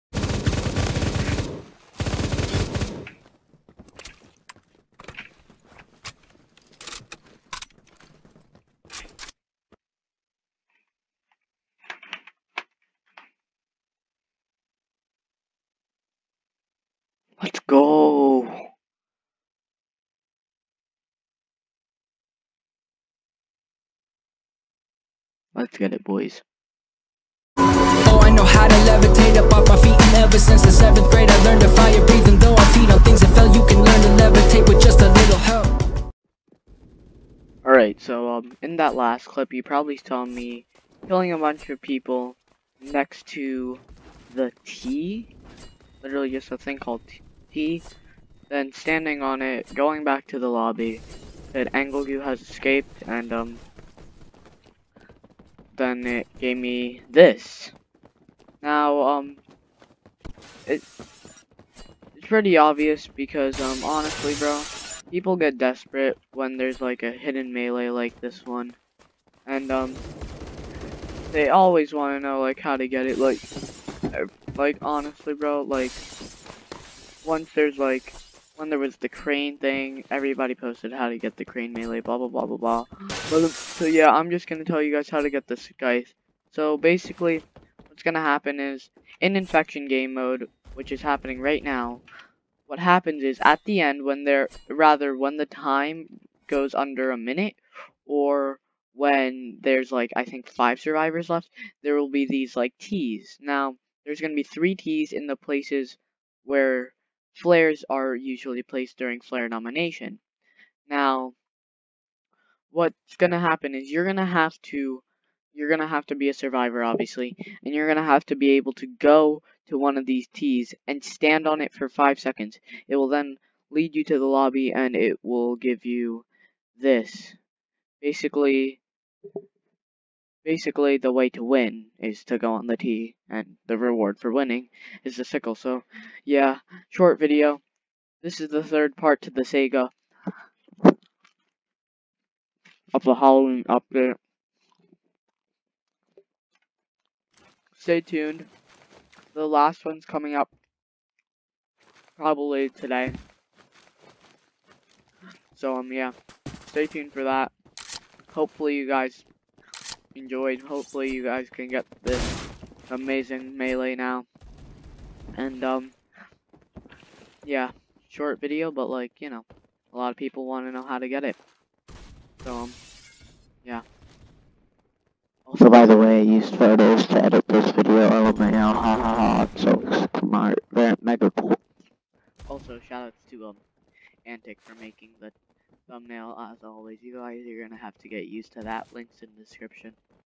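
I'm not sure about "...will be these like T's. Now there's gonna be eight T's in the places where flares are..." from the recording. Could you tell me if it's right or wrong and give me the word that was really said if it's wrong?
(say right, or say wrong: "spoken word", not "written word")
wrong: "three", not "eight".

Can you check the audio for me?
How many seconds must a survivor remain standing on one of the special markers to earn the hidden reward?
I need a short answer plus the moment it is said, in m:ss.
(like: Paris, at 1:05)
5, at 2:01.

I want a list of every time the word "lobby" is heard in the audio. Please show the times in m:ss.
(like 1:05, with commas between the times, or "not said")
0:50, 2:04.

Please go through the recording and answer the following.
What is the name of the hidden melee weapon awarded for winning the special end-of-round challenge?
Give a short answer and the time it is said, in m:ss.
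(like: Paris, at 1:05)
Sickle, at 2:15.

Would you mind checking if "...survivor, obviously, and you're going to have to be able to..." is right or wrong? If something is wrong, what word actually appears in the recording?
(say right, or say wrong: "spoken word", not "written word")
right.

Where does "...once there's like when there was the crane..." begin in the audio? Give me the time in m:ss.
1:17.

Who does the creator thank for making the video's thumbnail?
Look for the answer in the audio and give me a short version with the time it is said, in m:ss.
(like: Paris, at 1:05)
Antic, at 3:04.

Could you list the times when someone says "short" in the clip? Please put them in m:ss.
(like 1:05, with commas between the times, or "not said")
2:16, 2:48.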